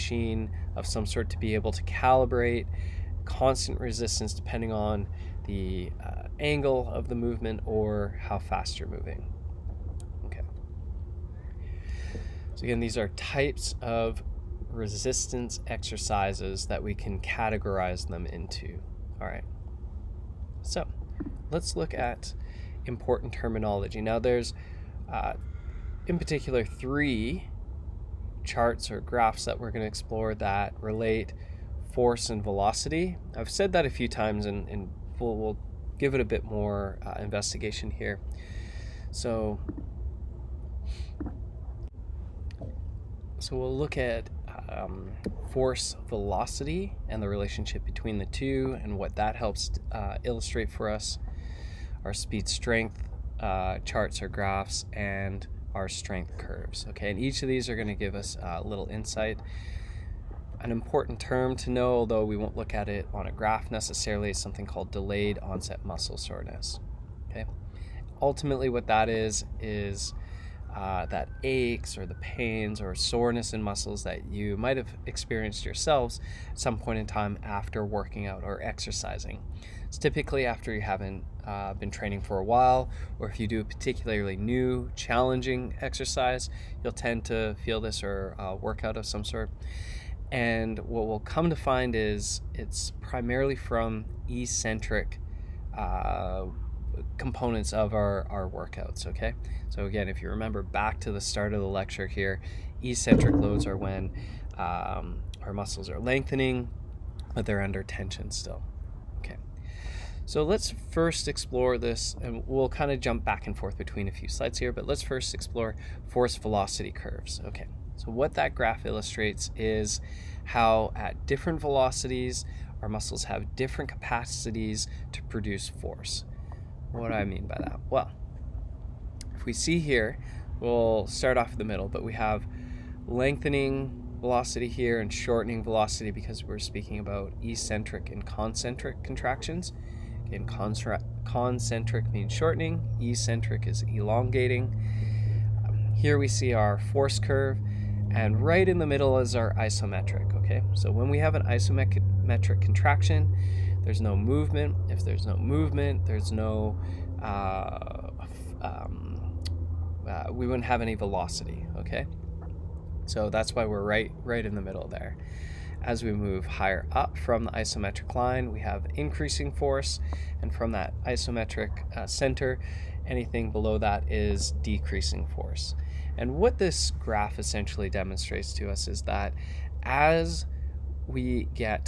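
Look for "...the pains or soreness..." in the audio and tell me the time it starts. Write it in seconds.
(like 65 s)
72 s.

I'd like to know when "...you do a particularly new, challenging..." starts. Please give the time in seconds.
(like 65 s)
83 s.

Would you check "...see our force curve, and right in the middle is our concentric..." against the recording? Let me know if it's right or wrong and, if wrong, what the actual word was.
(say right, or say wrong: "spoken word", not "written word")
wrong: "isometric", not "concentric".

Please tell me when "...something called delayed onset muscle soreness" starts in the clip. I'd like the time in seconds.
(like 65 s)
64 s.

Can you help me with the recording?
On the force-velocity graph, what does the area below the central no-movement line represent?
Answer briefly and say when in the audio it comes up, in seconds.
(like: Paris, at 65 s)
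Decreasing force, at 174 s.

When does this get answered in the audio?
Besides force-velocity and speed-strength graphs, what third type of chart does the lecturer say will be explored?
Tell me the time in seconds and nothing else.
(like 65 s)
55 s.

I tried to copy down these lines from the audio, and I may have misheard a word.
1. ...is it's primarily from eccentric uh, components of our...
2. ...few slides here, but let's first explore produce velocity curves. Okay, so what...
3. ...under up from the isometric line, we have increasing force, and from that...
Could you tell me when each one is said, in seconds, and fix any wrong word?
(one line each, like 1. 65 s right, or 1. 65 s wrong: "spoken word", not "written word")
1. 91 s right
2. 114 s wrong: "force", not "produce"
3. 166 s wrong: "higher", not "under".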